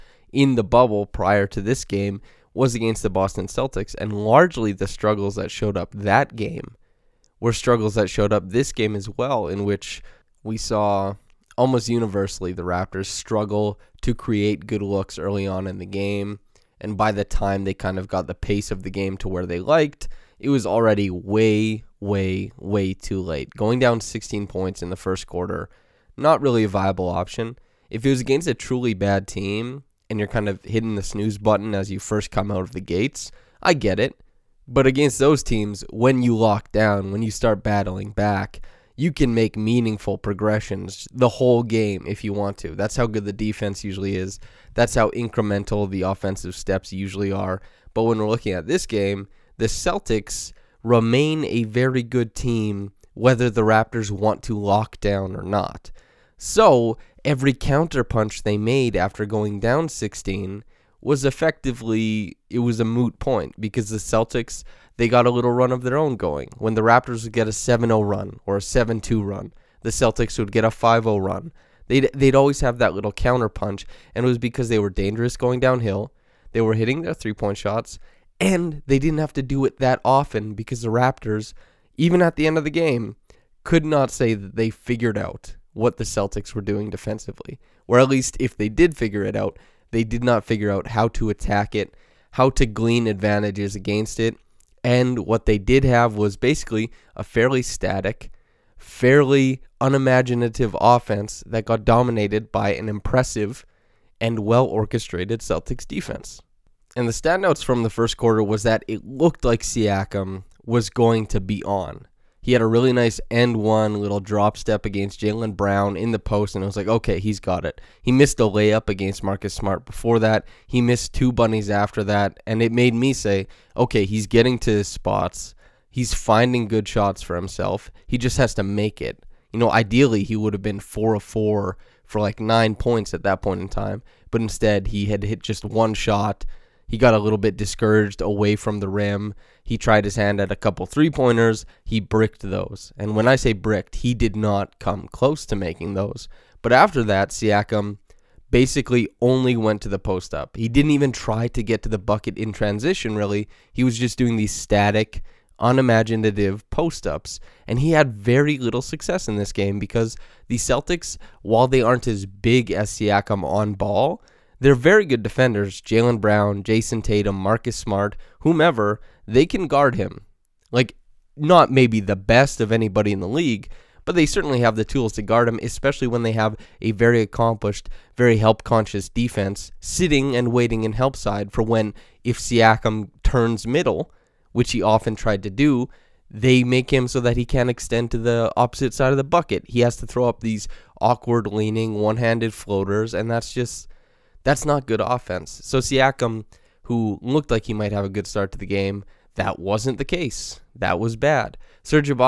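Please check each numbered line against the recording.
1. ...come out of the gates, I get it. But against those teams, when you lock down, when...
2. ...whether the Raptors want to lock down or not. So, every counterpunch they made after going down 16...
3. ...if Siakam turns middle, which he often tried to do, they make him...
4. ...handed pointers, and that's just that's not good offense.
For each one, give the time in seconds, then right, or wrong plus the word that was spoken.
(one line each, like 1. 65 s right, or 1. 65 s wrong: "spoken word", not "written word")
1. 32 s right
2. 53 s right
3. 182 s right
4. 192 s wrong: "floaters", not "pointers".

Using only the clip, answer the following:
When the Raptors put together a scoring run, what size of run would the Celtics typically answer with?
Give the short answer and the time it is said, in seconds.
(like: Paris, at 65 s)
5-0, at 70 s.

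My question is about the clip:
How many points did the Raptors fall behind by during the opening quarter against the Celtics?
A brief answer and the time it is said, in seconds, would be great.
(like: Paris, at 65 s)
16, at 24 s.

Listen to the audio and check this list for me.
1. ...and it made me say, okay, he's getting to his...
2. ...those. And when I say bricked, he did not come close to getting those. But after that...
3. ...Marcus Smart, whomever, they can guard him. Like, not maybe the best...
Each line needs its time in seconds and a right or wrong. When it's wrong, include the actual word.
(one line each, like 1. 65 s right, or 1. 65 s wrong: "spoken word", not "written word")
1. 122 s right
2. 142 s wrong: "making", not "getting"
3. 167 s right.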